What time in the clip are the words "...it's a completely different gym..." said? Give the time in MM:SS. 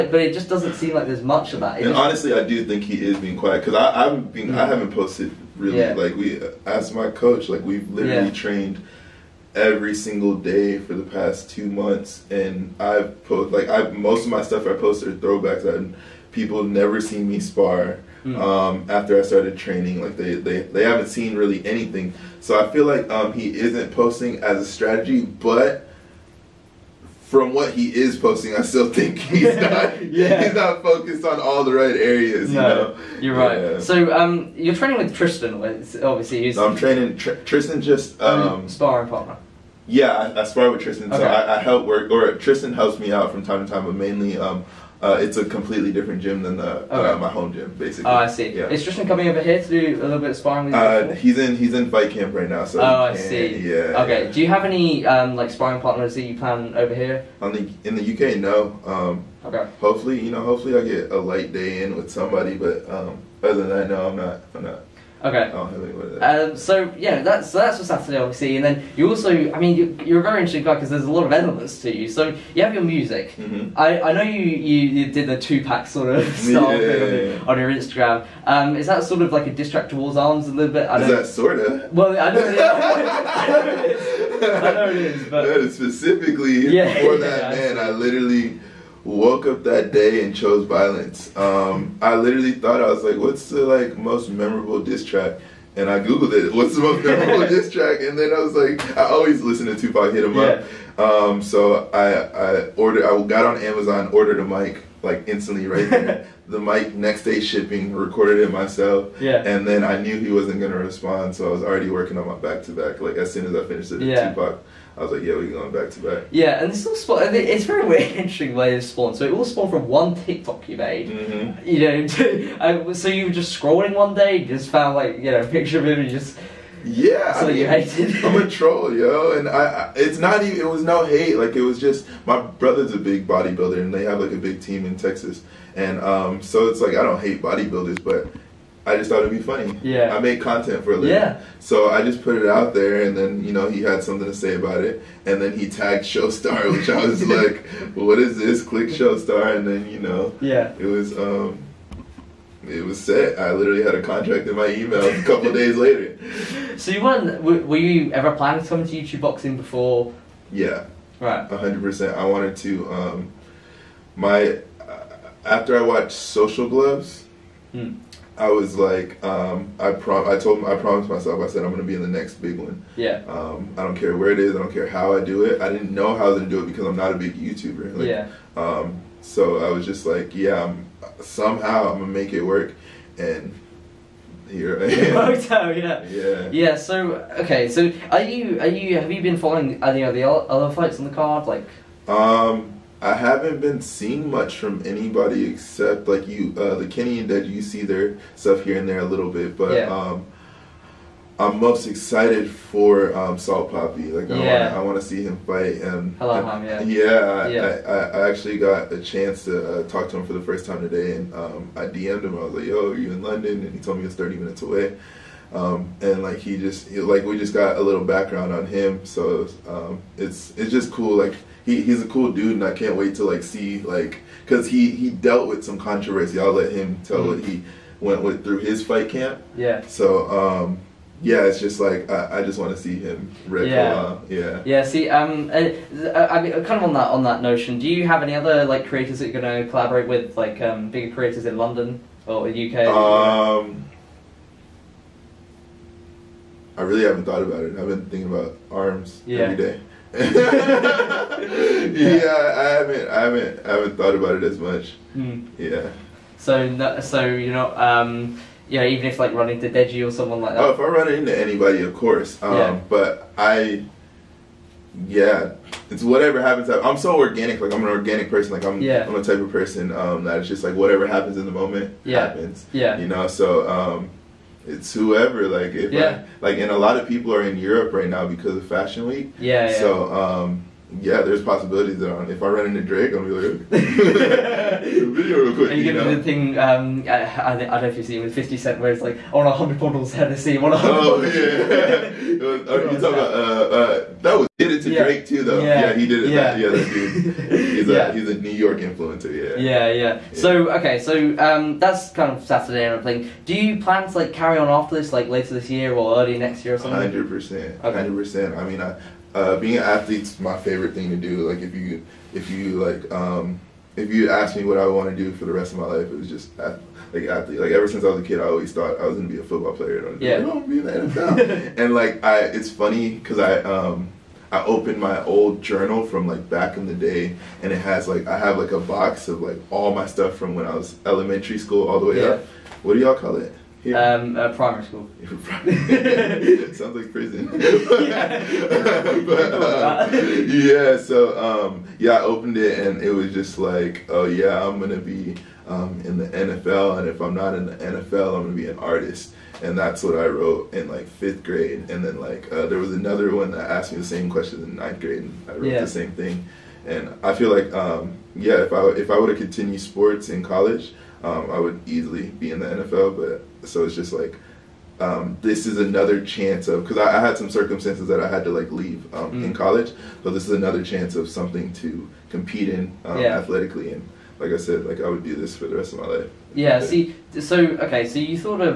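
00:45.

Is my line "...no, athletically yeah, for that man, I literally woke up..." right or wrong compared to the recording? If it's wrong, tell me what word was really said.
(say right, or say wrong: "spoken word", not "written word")
wrong: "specifically", not "athletically".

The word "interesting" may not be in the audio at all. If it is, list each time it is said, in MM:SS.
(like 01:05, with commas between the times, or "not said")
01:10, 01:58.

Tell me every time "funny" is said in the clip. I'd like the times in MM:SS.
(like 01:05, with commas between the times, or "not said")
02:19, 05:22.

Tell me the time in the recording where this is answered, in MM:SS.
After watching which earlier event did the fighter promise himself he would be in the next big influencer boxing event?
02:46.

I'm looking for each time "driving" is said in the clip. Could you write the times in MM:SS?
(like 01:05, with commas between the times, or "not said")
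not said.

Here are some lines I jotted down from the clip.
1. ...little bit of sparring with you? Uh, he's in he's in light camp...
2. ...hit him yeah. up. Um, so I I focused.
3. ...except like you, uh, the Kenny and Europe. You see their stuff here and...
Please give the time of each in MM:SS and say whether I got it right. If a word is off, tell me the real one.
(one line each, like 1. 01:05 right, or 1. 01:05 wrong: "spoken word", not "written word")
1. 00:50 wrong: "fight", not "light"
2. 01:40 wrong: "ordered", not "focused"
3. 03:15 wrong: "Dead", not "Europe".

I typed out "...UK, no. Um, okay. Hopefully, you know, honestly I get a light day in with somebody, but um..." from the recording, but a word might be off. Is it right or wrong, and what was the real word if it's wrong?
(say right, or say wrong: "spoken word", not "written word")
wrong: "hopefully", not "honestly".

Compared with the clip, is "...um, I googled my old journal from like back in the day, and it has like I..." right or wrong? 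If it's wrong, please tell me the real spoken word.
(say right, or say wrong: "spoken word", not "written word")
wrong: "opened", not "googled".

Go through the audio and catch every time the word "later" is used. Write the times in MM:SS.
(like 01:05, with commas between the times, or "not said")
02:35, 05:05.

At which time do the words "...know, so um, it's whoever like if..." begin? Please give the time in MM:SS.
04:33.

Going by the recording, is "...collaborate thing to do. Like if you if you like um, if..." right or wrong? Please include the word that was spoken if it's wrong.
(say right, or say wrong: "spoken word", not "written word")
wrong: "favorite", not "collaborate".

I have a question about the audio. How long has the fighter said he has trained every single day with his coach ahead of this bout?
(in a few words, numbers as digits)
2 months.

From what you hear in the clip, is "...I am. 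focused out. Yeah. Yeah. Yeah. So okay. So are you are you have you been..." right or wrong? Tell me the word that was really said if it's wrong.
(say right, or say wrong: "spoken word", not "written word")
wrong: "worked", not "focused".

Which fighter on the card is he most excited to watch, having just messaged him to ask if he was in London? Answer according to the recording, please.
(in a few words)
Salt Papi.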